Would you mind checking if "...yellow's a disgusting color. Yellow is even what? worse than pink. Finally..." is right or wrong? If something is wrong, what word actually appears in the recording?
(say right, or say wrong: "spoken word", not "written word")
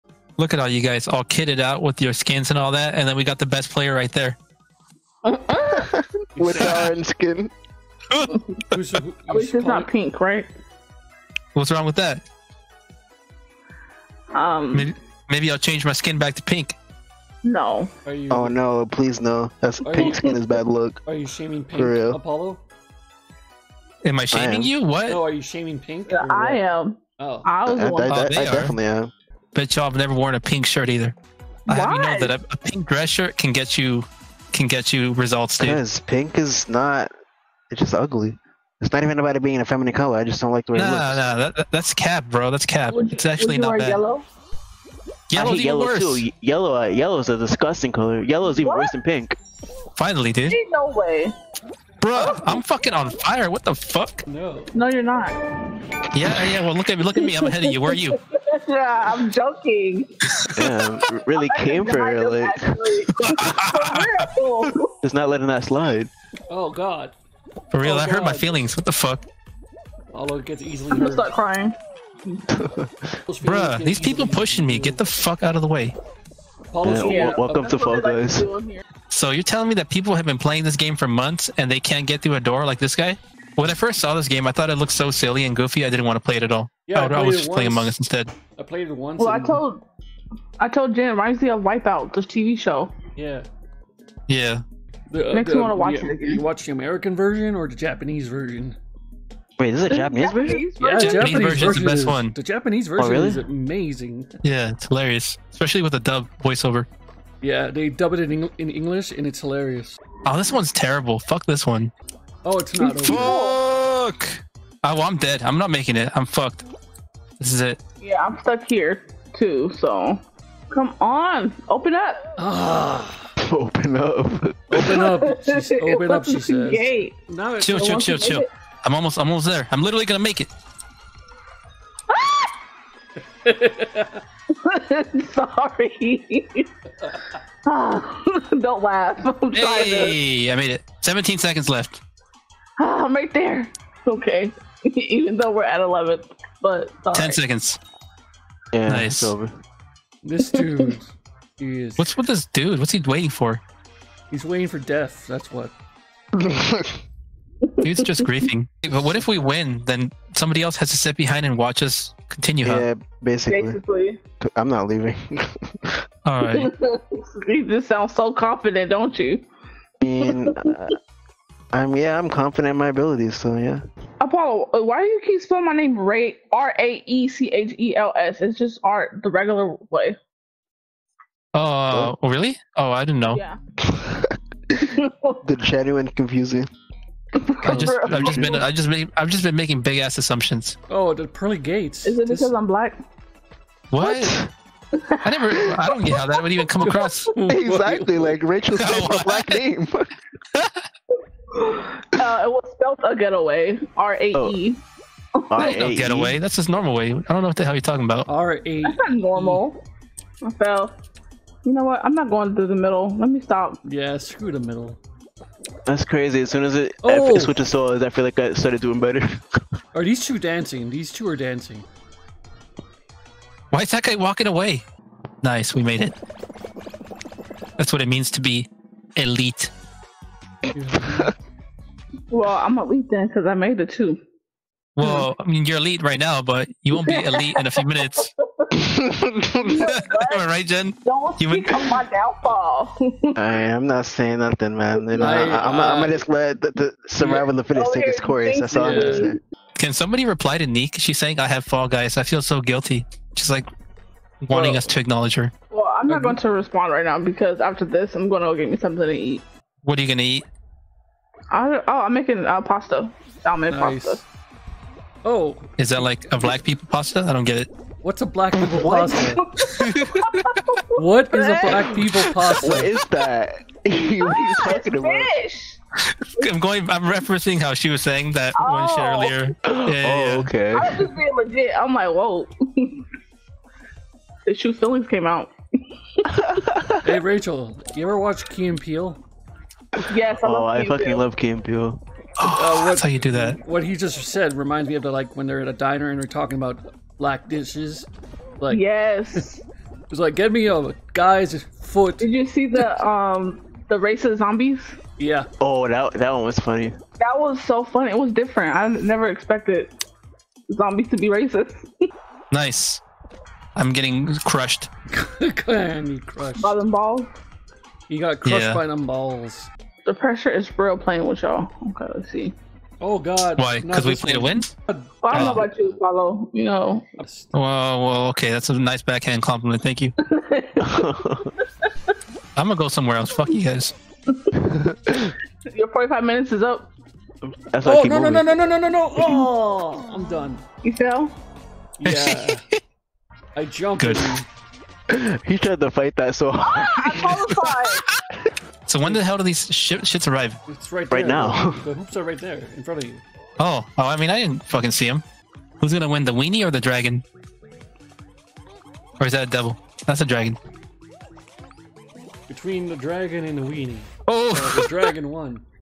right.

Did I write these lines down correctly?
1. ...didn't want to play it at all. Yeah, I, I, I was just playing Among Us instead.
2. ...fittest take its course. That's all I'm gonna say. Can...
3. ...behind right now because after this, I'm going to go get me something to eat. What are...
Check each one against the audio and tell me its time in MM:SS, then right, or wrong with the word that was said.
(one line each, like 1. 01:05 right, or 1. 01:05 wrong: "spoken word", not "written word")
1. 01:25 right
2. 04:07 right
3. 04:16 wrong: "respond", not "behind".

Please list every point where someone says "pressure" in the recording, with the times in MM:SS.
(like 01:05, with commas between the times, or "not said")
05:20.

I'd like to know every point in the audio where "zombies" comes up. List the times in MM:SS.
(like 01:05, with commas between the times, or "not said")
05:04, 05:10.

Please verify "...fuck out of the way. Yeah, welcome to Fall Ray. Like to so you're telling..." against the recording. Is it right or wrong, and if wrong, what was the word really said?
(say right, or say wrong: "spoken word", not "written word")
wrong: "Guys", not "Ray".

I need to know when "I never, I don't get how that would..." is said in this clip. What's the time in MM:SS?
03:15.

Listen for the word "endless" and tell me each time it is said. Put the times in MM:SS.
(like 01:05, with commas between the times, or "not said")
not said.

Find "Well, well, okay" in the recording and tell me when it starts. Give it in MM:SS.
05:27.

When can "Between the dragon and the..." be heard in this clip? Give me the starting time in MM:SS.
06:02.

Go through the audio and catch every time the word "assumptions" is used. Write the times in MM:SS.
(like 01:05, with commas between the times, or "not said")
03:10.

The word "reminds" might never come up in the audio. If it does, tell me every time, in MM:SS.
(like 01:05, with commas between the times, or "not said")
01:31, 04:54.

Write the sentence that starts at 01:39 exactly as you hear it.
Wait, is is a Japanese, Japanese version?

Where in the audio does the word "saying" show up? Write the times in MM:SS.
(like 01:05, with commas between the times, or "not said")
04:04, 04:11, 04:38.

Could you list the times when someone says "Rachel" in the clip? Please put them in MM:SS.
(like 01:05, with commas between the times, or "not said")
03:18, 04:47.